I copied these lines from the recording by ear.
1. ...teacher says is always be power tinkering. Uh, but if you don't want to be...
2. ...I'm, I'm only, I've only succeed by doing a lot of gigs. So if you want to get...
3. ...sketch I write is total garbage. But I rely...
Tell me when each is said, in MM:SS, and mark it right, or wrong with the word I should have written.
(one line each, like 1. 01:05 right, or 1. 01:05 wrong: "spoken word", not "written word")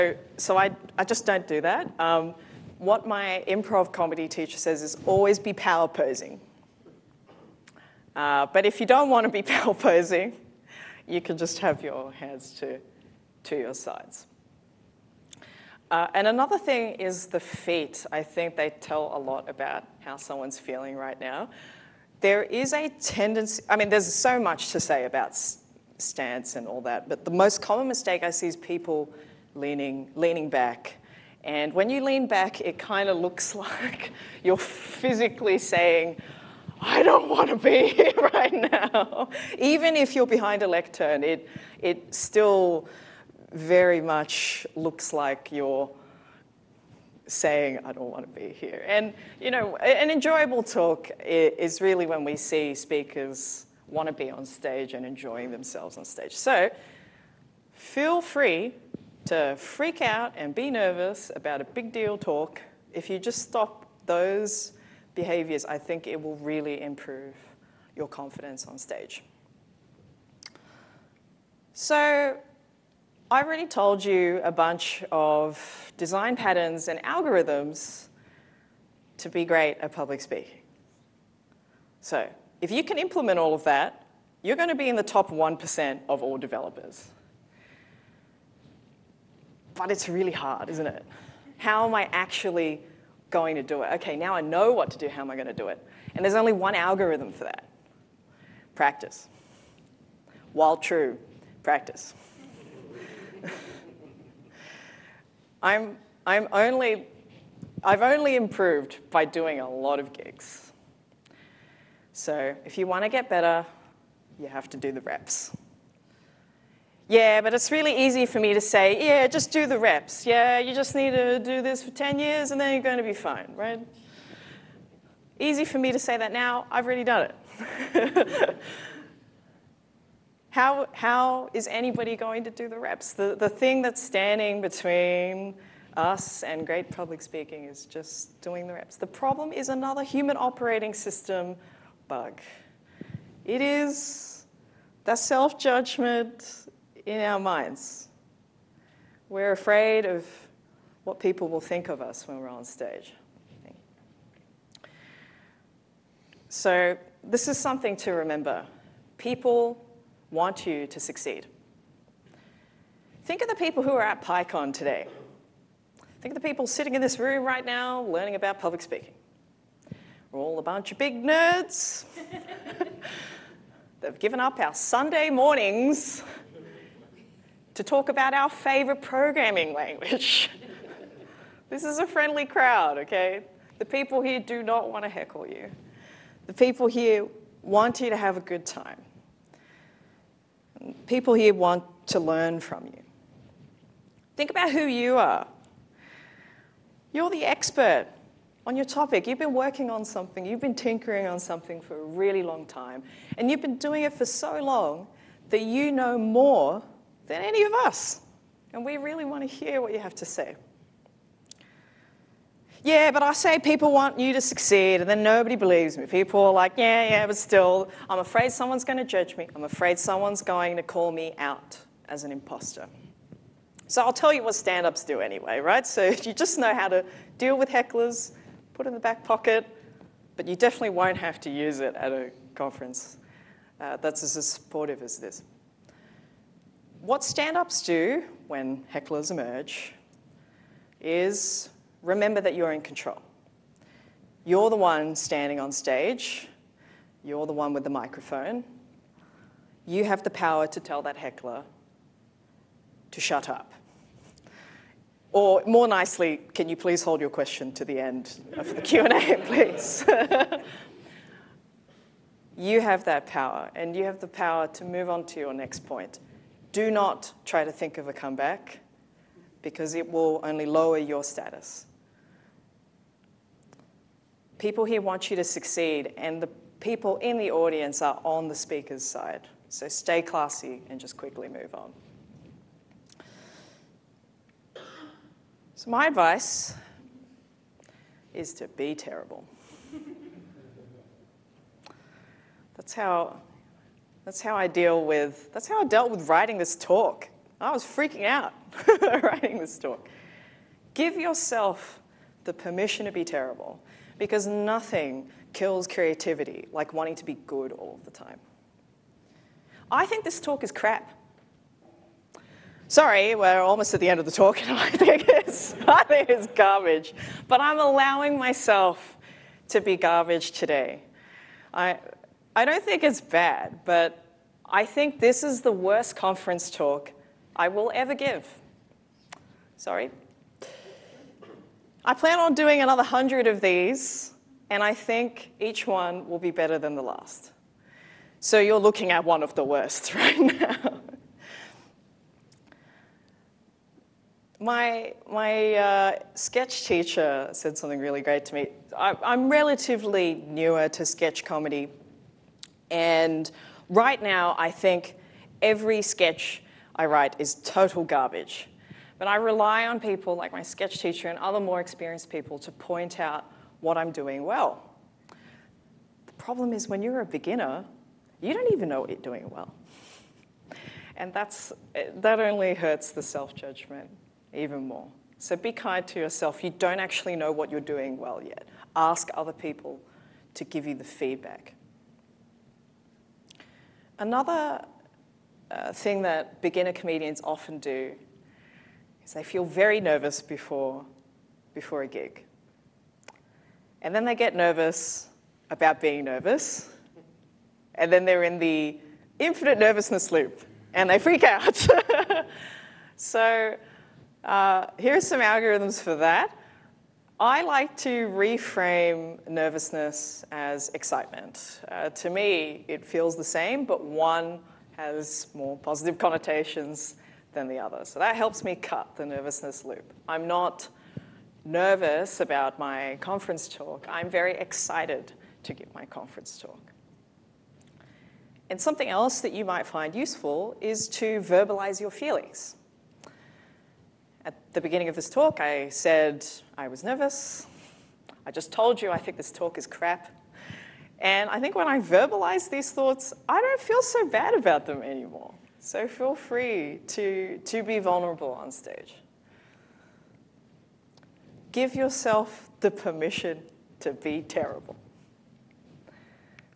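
1. 00:04 wrong: "posing", not "tinkering"
2. 01:45 wrong: "improved", not "succeed"
3. 05:56 right.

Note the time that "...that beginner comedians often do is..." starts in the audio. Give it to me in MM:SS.
06:26.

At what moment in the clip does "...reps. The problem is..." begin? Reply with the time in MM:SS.
02:18.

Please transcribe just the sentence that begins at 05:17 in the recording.
But I'm allowing myself to be garbage today.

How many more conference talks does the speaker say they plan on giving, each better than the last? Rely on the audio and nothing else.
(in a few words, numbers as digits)
100.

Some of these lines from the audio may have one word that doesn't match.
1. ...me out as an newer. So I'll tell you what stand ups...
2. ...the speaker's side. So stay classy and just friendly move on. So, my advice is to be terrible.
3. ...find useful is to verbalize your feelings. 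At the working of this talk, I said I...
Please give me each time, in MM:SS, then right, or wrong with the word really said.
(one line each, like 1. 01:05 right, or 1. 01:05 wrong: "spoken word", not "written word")
1. 03:41 wrong: "imposter", not "newer"
2. 04:38 wrong: "quickly", not "friendly"
3. 07:09 wrong: "beginning", not "working".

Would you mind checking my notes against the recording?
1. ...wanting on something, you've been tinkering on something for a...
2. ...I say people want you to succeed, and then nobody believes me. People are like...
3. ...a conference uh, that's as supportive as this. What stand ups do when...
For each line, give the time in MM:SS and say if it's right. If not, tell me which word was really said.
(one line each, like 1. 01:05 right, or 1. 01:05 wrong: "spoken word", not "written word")
1. 03:19 wrong: "working", not "wanting"
2. 03:33 right
3. 03:52 right.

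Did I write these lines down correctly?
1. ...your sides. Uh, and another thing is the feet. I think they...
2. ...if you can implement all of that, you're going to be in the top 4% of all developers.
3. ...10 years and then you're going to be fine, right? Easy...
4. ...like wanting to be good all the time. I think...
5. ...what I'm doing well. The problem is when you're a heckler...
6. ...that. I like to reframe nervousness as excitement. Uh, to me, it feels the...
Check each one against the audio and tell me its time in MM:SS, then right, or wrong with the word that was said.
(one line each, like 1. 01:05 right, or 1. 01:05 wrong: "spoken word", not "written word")
1. 00:13 right
2. 01:22 wrong: "1", not "4"
3. 02:01 right
4. 05:06 right
5. 06:03 wrong: "beginner", not "heckler"
6. 06:46 right.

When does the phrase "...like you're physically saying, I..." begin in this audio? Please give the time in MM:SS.
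00:33.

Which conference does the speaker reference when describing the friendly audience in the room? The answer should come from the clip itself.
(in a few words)
PyCon.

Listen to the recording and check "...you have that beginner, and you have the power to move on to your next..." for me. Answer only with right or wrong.
wrong.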